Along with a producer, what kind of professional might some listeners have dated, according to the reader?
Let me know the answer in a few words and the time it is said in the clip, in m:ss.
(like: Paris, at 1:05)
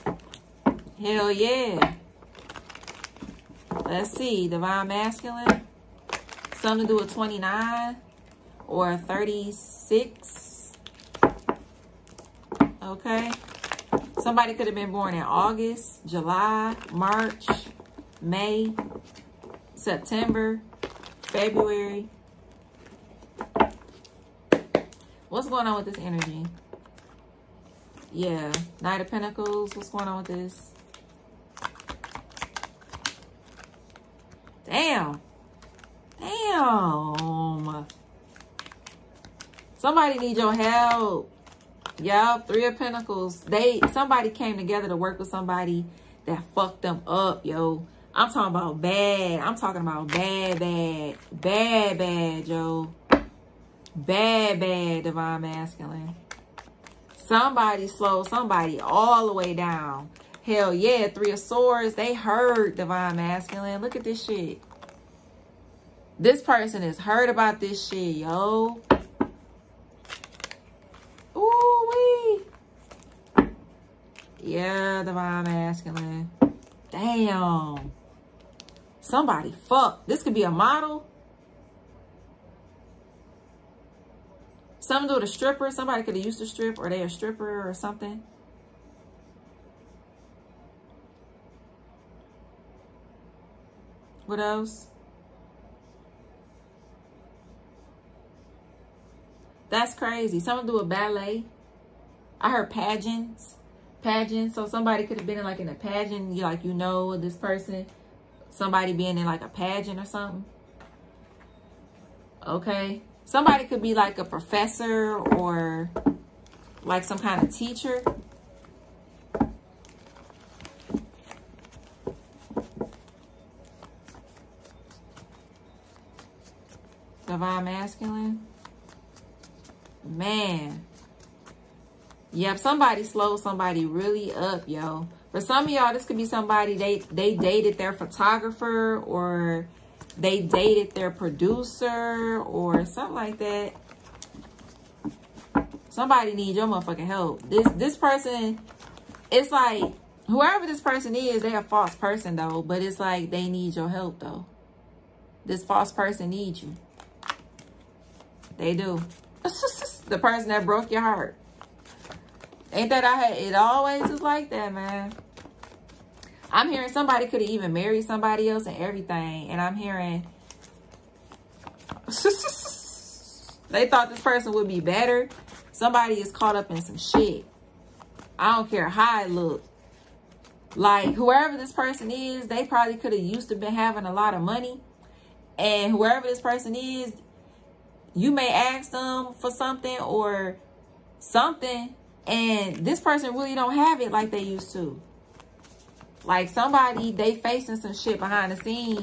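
Photographer, at 2:17.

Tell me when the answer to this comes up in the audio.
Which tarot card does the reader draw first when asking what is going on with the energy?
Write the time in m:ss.
0:28.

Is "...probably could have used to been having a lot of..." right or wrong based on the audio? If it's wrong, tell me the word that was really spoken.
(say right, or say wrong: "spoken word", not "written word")
right.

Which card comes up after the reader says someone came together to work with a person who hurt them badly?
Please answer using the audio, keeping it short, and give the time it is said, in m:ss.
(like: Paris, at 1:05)
Three of Pentacles, at 0:42.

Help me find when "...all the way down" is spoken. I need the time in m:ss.
0:58.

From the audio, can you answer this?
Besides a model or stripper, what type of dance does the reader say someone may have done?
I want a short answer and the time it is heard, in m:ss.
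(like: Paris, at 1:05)
Ballet, at 1:40.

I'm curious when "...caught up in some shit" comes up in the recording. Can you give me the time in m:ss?
2:56.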